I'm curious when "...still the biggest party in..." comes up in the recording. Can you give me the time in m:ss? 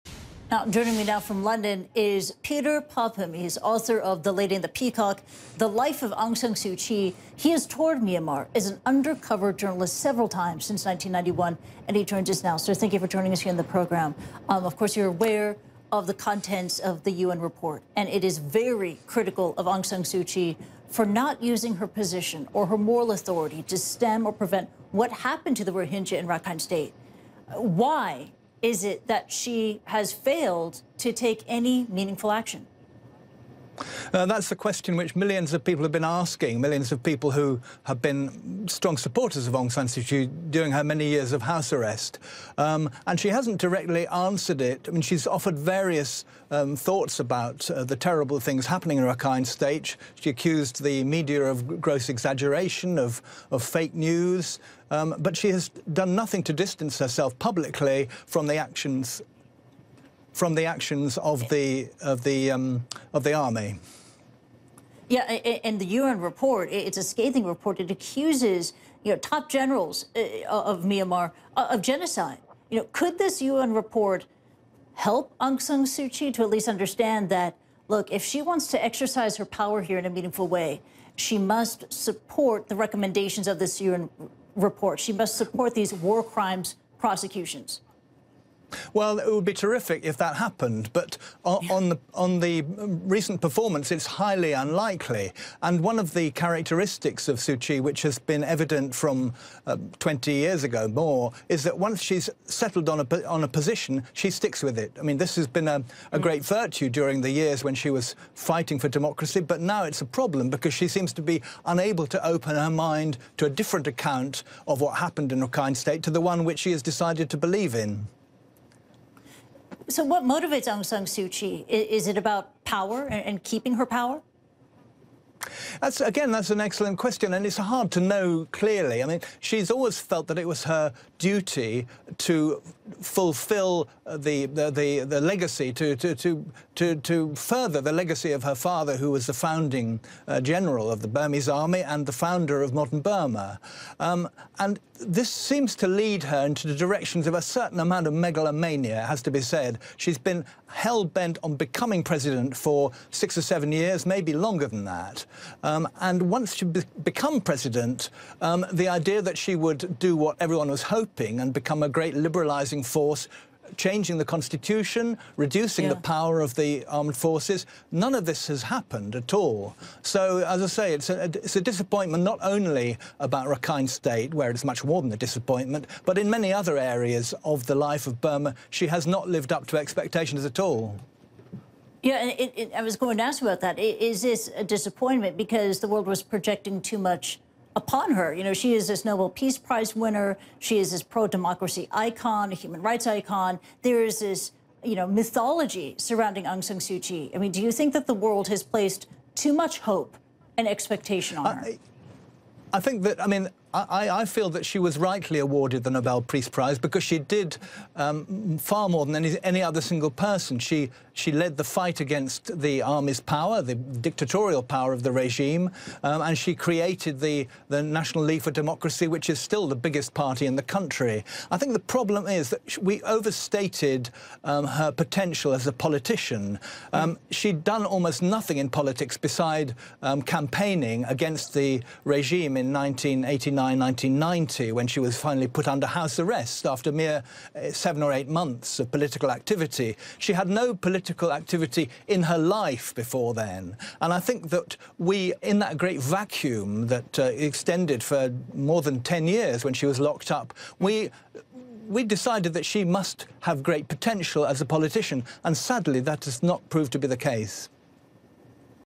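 3:39.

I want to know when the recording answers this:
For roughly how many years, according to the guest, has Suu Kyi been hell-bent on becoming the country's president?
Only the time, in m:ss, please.
2:33.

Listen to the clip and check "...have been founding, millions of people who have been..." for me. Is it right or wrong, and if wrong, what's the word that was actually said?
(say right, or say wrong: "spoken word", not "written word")
wrong: "asking", not "founding".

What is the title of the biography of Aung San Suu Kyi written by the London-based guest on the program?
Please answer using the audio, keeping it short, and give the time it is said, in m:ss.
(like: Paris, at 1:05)
The Lady and the Peacock, at 0:04.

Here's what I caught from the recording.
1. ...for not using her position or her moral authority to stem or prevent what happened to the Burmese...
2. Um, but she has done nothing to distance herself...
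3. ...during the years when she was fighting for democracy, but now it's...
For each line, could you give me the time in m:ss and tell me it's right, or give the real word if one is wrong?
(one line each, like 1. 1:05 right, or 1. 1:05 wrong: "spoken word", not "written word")
1. 0:20 wrong: "Rohingya", not "Burmese"
2. 0:54 right
3. 1:46 right.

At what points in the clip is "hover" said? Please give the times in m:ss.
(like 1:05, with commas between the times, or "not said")
not said.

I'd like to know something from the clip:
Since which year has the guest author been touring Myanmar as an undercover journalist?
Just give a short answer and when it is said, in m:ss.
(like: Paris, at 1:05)
1991, at 0:10.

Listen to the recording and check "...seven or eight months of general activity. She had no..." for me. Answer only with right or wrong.
wrong.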